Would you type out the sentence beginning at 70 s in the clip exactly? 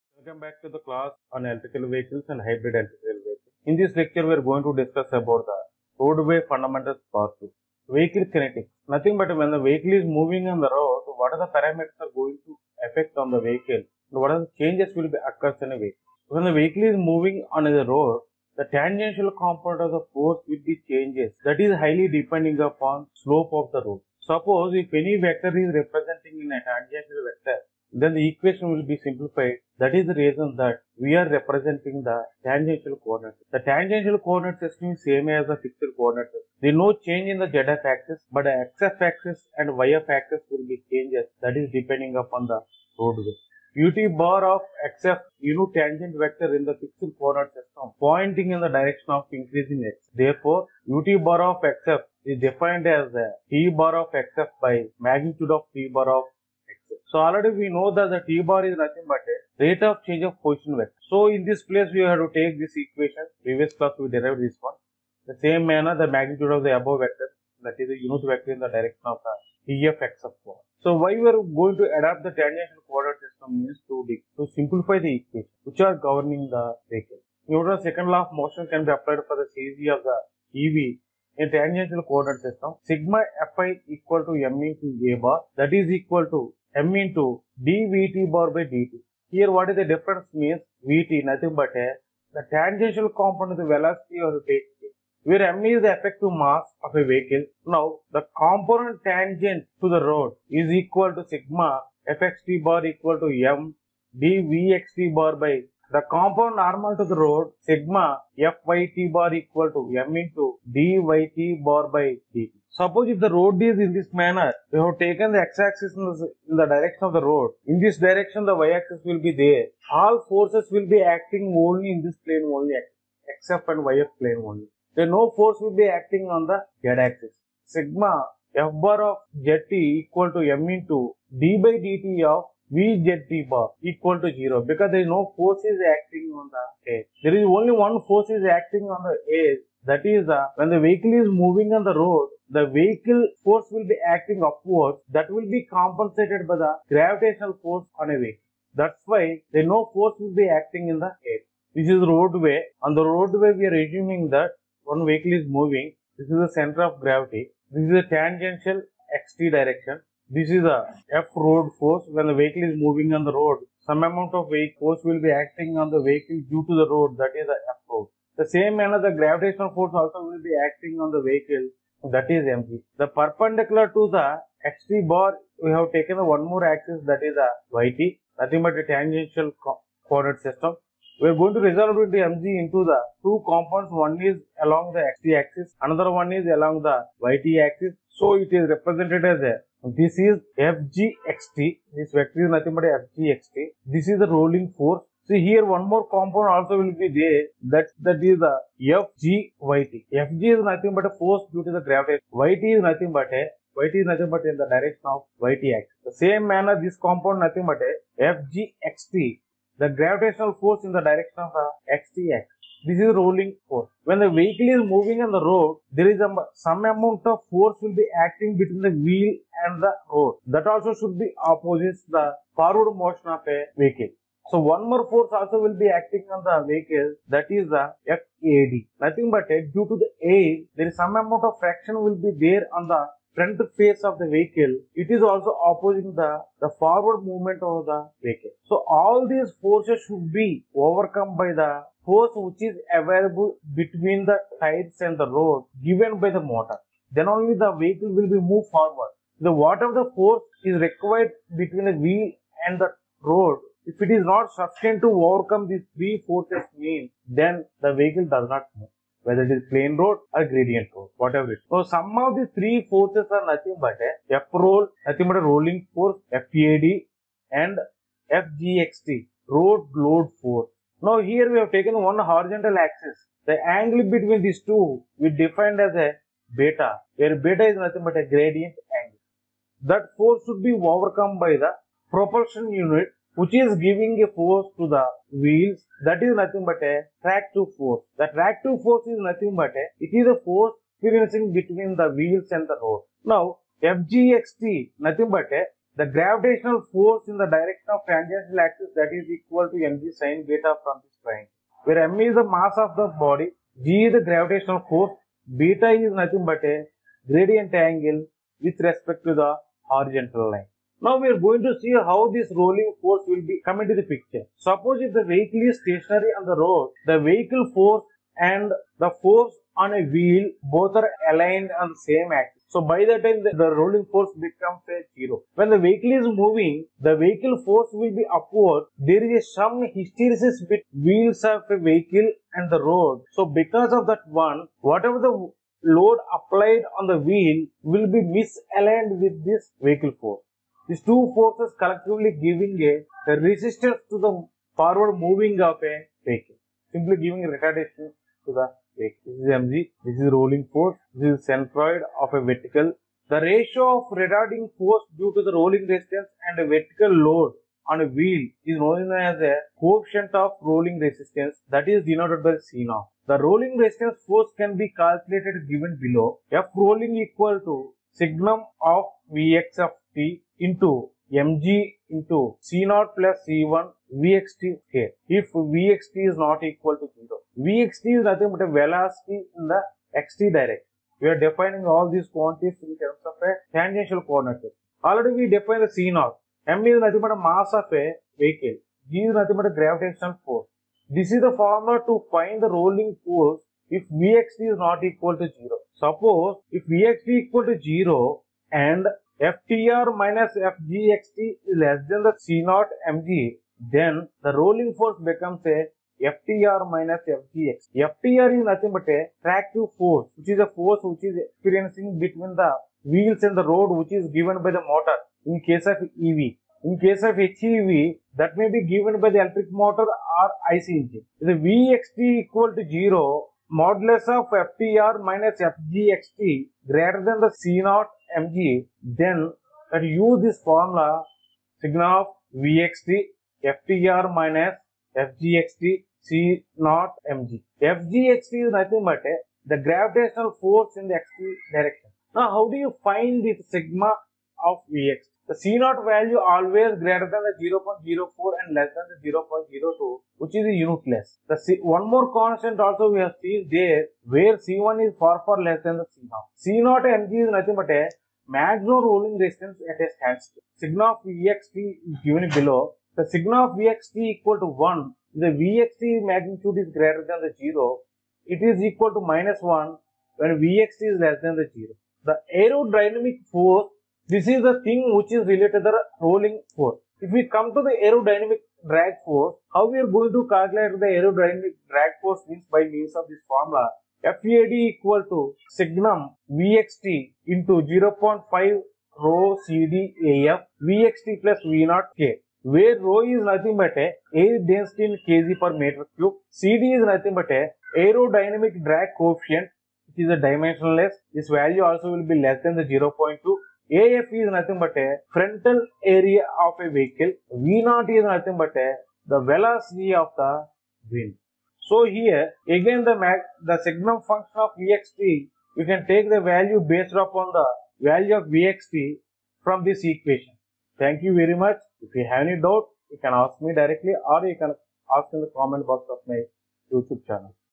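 So why we are going to adapt the tangential coordinate system means to, to simplify the equation which are governing the vehicle.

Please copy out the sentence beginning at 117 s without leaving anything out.
In this direction, the y-axis will be there.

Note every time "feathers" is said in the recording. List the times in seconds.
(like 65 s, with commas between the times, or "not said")
not said.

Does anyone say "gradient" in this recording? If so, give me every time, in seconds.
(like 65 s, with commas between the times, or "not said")
260 s, 278 s, 307 s.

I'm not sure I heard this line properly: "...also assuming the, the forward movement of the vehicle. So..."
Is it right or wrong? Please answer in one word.
wrong.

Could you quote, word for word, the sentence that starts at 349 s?
This is mg, this is rolling force, this is centroid of a vertical.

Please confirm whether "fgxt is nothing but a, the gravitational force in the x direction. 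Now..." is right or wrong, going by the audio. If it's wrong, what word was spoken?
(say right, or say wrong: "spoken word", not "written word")
right.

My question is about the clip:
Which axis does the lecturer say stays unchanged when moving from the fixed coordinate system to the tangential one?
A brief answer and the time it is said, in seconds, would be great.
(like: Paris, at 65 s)
zf axis, at 37 s.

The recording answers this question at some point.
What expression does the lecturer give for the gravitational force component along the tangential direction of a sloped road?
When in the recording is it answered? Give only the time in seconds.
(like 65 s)
299 s.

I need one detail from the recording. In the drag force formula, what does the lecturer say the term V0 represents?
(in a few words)
velocity of the wind.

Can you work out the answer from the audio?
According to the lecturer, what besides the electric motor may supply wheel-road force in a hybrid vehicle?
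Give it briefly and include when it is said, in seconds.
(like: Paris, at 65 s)
IC engine, at 420 s.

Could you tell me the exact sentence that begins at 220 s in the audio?
That also should be opposite the forward motion of a vehicle.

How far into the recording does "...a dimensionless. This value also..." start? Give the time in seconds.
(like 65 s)
500 s.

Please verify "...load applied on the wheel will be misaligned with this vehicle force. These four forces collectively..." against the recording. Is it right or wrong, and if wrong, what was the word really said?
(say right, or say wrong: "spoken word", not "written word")
wrong: "two", not "four".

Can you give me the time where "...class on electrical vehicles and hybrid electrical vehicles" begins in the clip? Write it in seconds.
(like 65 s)
0 s.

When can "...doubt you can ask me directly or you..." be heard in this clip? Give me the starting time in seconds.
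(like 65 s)
522 s.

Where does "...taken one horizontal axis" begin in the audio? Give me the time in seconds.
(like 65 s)
271 s.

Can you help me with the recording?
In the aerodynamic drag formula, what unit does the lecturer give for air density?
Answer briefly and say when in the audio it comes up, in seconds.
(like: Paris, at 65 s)
kg per meter cube, at 495 s.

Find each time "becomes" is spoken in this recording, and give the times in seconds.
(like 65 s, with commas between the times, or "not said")
324 s, 405 s.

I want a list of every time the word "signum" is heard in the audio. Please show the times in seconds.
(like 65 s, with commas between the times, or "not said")
368 s, 485 s, 513 s.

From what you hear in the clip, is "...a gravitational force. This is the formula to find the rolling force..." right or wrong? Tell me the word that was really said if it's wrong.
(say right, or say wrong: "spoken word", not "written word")
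right.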